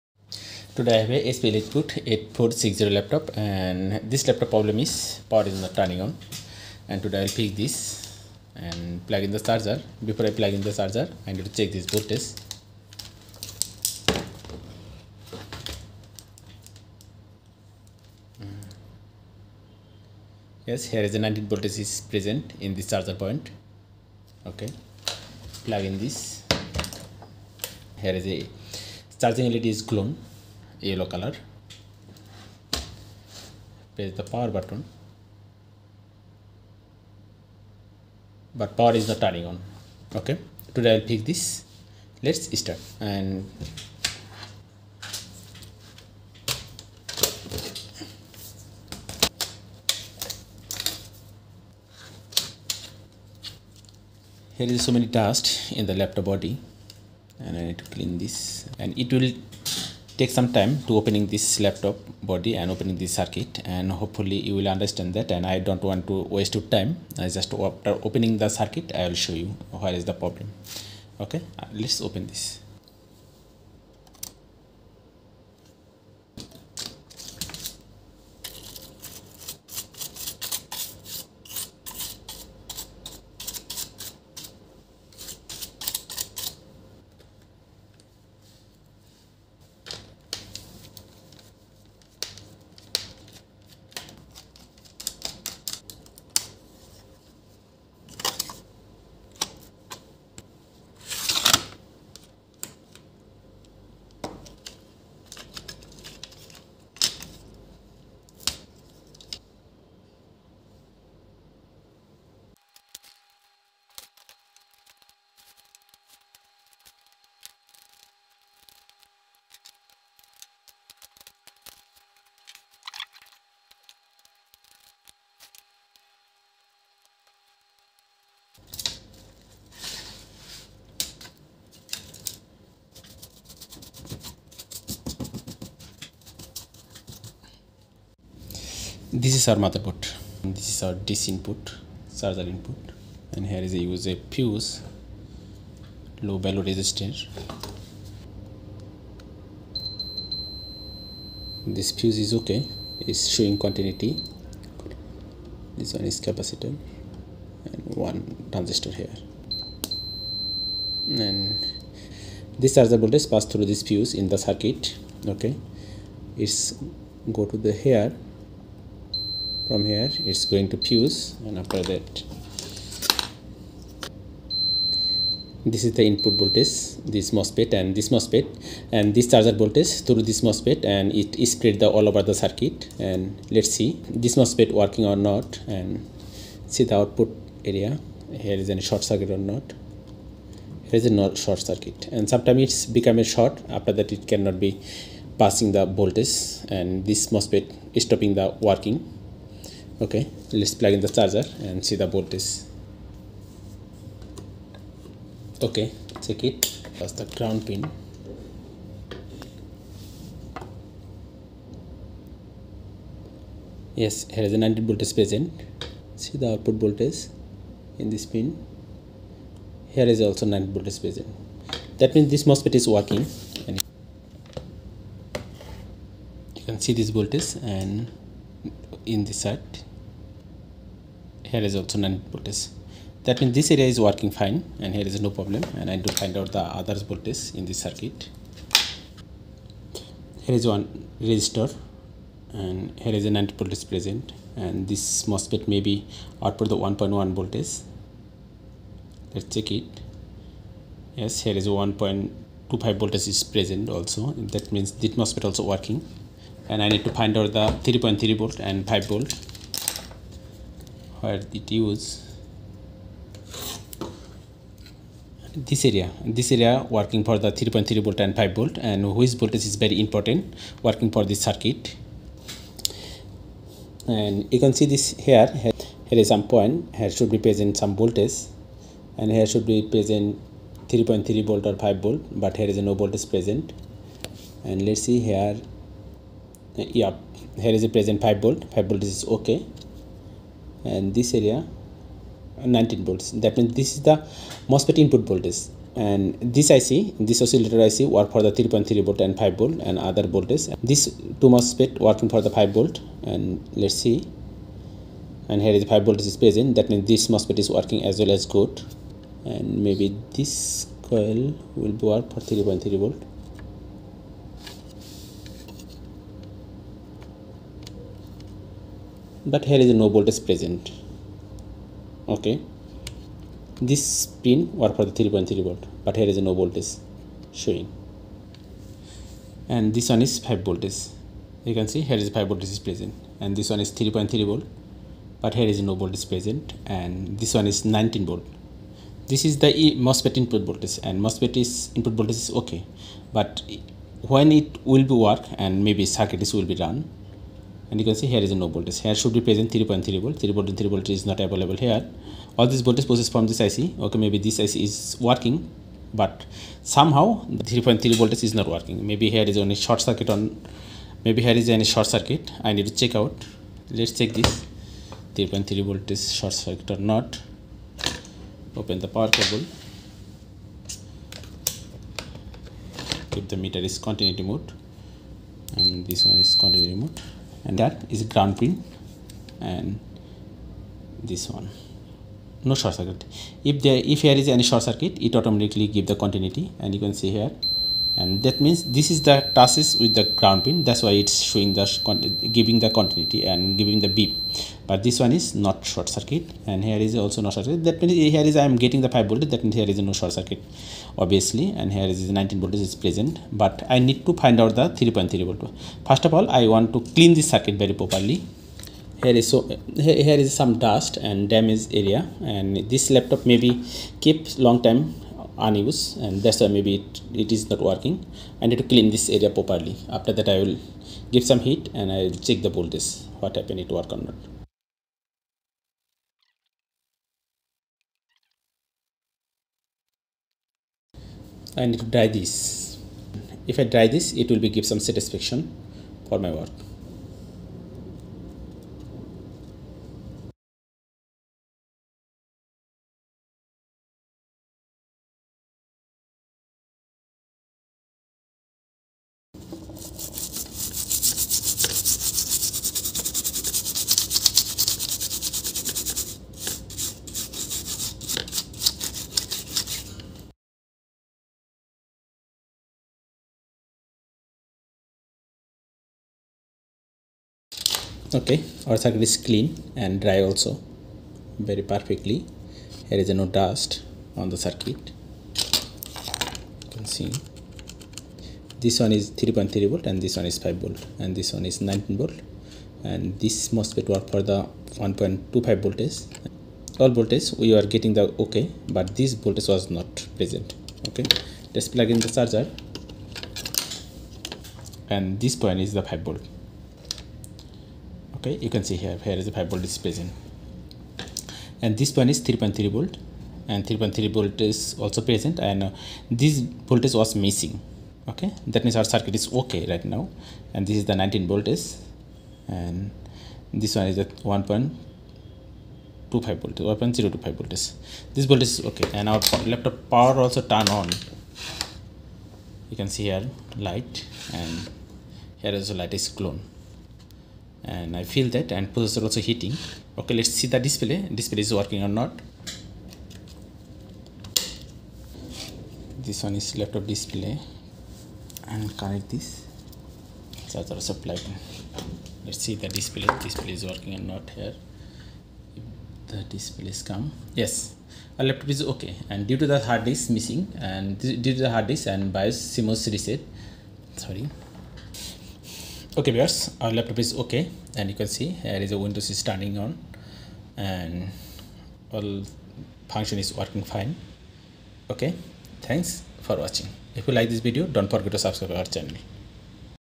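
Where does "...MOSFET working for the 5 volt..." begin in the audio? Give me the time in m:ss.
5:01.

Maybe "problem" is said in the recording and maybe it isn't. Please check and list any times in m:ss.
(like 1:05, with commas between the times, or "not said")
0:04, 1:10, 3:55.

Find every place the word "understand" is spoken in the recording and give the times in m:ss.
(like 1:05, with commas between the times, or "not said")
1:04.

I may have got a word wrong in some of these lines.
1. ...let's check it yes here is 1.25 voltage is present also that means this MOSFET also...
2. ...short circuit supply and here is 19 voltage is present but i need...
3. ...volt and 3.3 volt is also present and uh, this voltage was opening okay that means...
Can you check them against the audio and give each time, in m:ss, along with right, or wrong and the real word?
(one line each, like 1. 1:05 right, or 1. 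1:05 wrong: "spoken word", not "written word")
1. 4:09 right
2. 6:40 wrong: "obviously", not "supply"
3. 8:22 wrong: "missing", not "opening".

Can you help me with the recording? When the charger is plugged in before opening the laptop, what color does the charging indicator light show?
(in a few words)
Yellow.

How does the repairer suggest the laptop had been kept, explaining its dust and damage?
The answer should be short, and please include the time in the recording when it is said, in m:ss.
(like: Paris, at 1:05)
Long time unused, at 6:54.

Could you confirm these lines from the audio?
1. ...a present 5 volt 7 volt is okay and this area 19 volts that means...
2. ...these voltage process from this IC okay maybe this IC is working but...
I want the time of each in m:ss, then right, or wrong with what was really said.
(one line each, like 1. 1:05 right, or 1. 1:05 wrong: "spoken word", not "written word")
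1. 4:47 wrong: "5", not "7"
2. 5:52 right.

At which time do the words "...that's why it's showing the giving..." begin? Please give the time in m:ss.
6:30.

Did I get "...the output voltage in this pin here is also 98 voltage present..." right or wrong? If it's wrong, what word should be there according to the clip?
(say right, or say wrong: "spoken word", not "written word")
wrong: "90", not "98".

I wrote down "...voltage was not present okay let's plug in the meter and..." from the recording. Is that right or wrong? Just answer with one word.
wrong.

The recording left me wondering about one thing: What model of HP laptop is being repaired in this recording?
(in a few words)
EliteBook 8460.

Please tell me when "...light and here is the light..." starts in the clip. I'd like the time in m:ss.
8:43.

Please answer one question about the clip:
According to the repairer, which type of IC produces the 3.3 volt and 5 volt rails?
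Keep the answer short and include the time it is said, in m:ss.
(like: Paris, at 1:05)
Oscillator IC, at 4:57.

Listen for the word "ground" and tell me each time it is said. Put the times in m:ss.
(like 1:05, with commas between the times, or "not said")
3:27, 6:18, 6:30.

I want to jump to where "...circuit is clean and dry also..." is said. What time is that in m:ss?
7:48.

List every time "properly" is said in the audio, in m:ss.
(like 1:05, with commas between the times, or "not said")
6:48, 6:59.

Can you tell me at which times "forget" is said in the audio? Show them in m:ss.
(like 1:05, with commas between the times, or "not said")
9:28.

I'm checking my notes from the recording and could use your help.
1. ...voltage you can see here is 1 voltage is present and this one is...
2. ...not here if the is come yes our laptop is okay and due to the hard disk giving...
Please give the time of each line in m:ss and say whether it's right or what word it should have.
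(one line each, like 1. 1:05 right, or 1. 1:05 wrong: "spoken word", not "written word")
1. 5:30 wrong: "5", not "1"
2. 9:04 wrong: "missing", not "giving".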